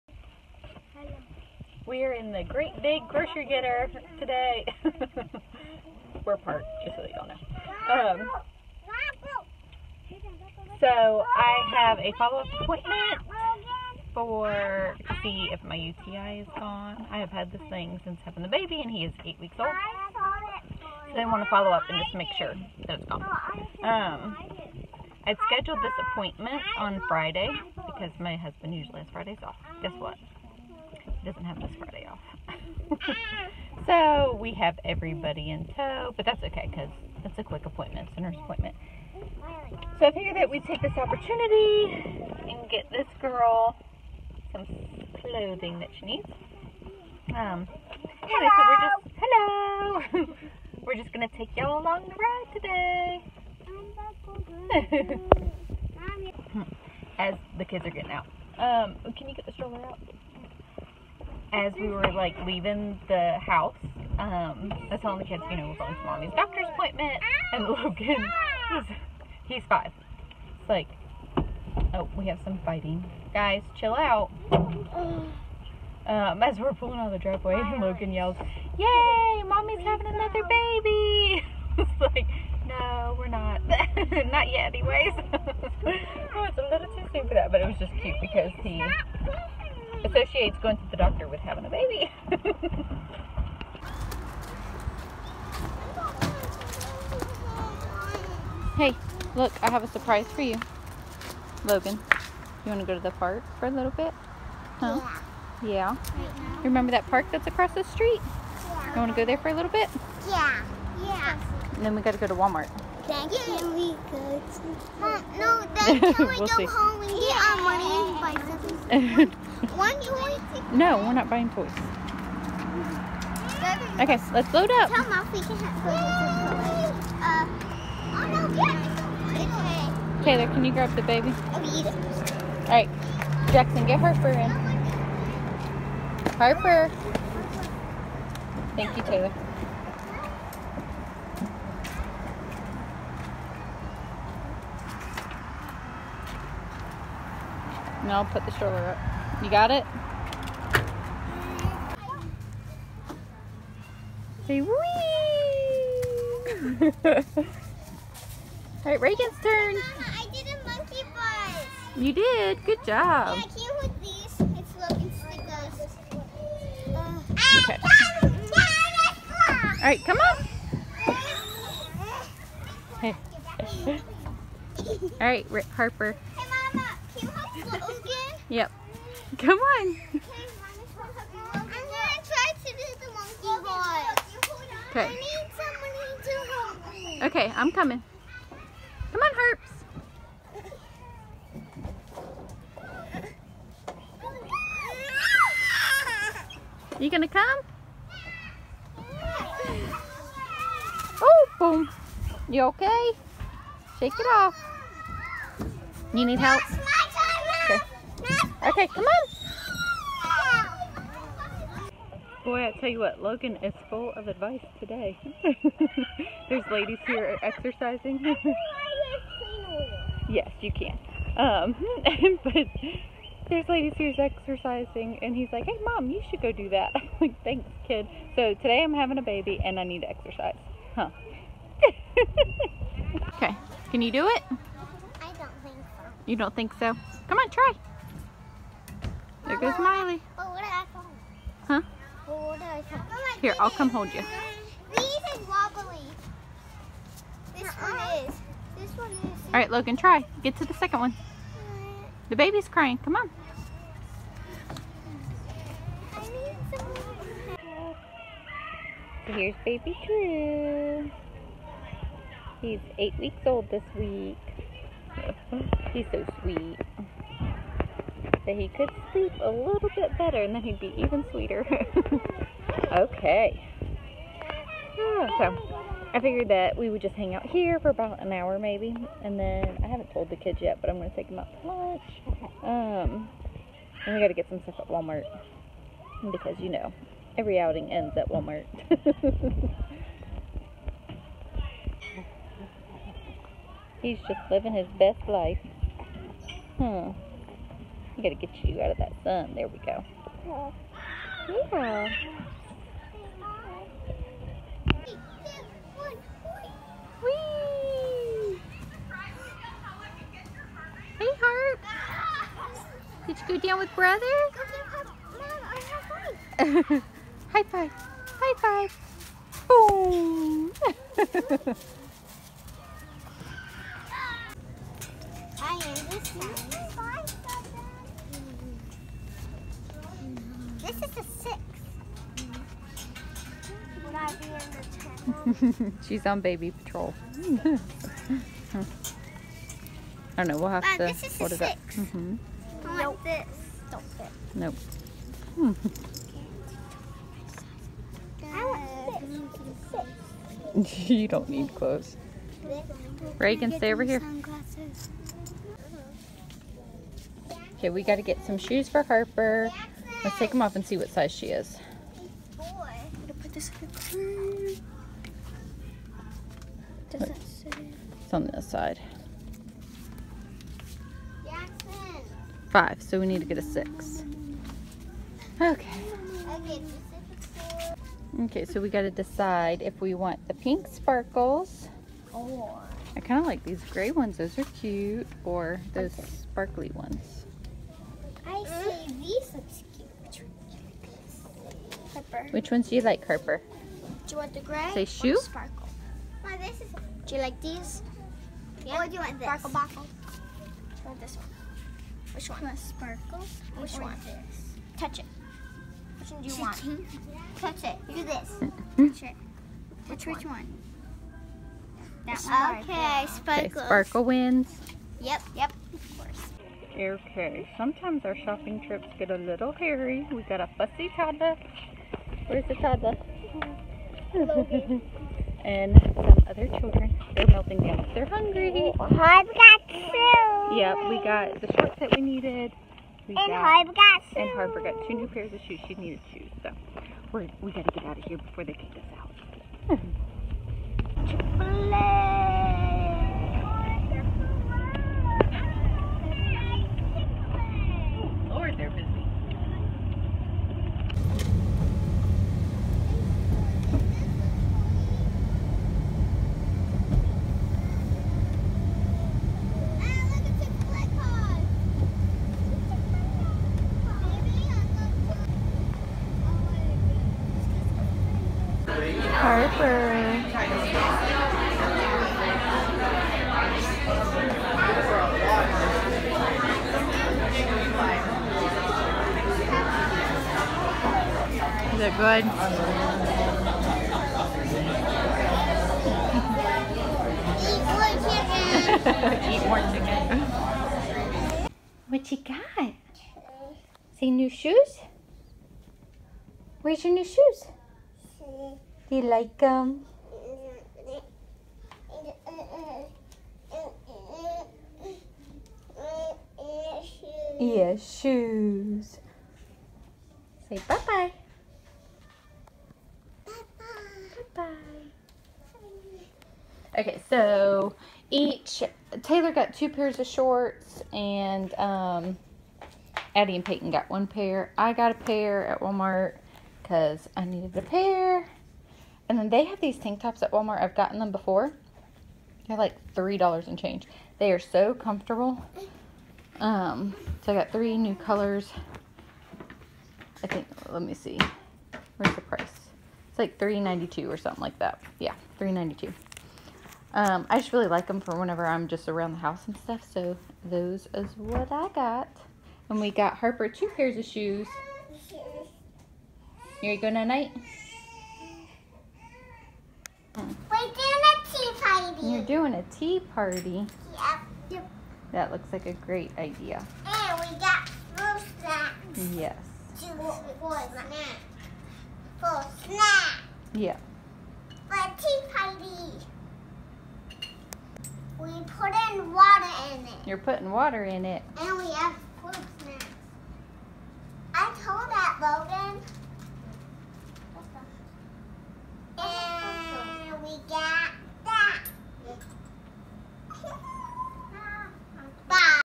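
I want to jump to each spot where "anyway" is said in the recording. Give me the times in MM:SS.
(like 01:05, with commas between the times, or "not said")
00:48, 01:24.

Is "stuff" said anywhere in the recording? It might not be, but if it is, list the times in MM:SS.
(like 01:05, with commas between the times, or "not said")
04:44, 09:09.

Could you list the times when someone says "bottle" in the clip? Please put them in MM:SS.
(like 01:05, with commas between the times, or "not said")
06:39.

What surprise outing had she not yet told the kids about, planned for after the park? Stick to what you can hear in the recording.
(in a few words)
Lunch.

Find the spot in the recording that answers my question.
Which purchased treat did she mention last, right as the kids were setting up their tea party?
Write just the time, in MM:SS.
09:27.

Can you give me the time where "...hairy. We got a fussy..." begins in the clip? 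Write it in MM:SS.
06:59.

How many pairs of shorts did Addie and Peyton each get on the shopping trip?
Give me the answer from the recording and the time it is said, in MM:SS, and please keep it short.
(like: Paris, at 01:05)
1, at 08:44.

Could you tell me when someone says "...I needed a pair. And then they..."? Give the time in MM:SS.
08:47.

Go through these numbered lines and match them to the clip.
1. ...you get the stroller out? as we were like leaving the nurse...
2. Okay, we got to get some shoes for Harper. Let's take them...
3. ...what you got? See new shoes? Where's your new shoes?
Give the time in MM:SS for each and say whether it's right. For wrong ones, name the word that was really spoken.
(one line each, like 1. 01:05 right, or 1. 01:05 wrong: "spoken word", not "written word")
1. 00:59 wrong: "house", not "nurse"
2. 05:57 right
3. 08:12 right.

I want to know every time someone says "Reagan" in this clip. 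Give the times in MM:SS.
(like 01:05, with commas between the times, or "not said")
02:39, 05:53.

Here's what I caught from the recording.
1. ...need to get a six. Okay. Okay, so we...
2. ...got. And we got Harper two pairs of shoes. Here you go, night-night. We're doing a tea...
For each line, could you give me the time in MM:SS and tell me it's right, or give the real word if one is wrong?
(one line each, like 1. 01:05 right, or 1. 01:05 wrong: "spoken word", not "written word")
1. 06:13 right
2. 09:11 right.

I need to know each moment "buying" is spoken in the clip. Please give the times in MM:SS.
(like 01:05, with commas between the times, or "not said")
02:01.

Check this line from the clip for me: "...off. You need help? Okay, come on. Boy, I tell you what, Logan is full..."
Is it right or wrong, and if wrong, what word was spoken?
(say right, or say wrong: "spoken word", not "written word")
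right.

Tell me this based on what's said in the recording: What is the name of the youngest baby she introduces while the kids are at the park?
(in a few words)
Drew.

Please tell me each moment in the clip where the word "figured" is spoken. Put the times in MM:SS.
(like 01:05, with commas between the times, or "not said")
00:40, 04:36.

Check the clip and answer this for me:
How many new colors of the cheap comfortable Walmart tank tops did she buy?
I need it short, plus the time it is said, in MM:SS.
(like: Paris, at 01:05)
3, at 08:57.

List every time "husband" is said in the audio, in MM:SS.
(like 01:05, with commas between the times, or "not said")
00:28.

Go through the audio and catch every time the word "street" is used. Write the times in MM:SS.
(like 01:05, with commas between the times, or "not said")
01:47.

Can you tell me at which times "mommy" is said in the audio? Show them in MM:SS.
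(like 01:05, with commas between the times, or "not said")
01:06, 01:19.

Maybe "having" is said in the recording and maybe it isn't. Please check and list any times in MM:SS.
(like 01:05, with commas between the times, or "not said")
00:18, 01:19, 01:31, 03:48.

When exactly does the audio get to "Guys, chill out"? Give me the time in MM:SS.
01:13.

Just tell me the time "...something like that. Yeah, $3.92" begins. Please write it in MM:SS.
09:04.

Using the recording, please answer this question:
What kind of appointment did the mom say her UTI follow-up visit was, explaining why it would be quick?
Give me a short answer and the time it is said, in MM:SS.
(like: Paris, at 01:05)
Nurse appointment, at 00:38.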